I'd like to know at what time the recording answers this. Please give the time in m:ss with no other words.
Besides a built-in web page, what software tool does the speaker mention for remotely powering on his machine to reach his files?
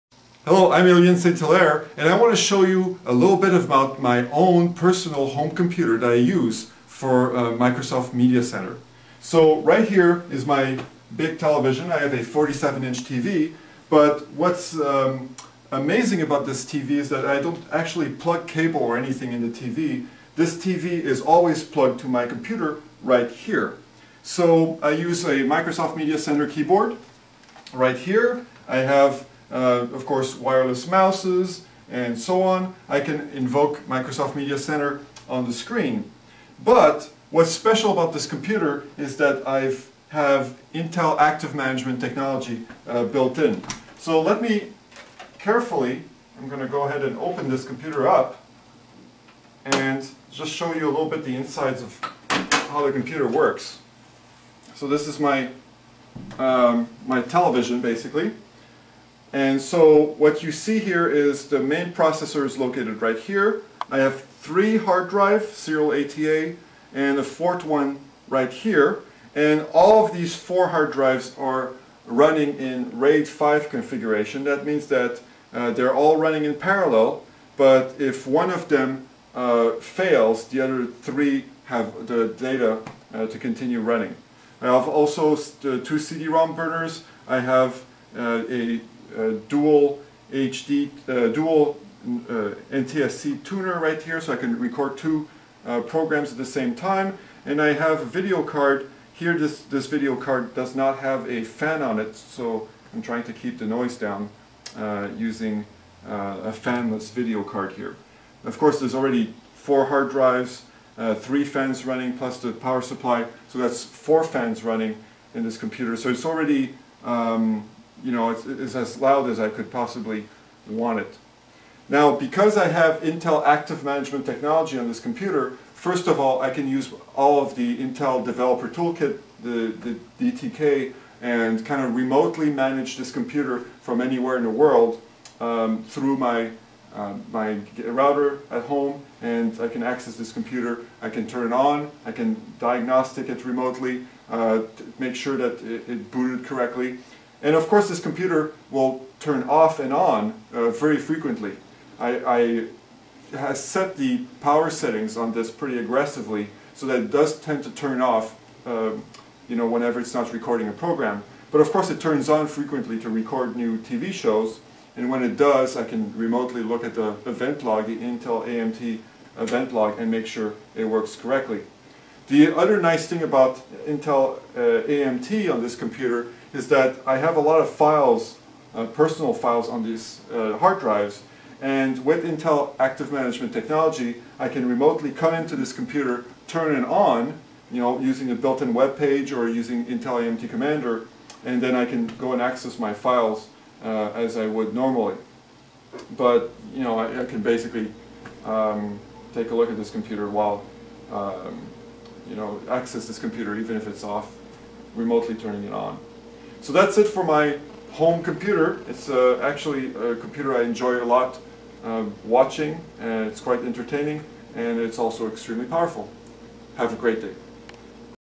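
3:09.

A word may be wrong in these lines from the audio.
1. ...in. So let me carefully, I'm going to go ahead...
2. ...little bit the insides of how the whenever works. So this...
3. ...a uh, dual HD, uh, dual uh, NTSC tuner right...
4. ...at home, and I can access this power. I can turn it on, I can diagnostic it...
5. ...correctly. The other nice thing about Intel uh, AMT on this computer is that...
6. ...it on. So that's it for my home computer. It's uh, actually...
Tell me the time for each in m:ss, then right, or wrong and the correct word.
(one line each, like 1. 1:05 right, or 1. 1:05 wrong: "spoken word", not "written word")
1. 0:43 right
2. 0:50 wrong: "computer", not "whenever"
3. 1:28 right
4. 2:18 wrong: "computer", not "power"
5. 2:51 right
6. 3:25 right.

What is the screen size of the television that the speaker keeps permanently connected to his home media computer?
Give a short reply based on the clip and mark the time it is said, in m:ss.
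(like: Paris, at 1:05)
47-inch, at 0:12.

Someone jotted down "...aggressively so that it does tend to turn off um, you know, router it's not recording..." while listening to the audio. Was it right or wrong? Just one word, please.
wrong.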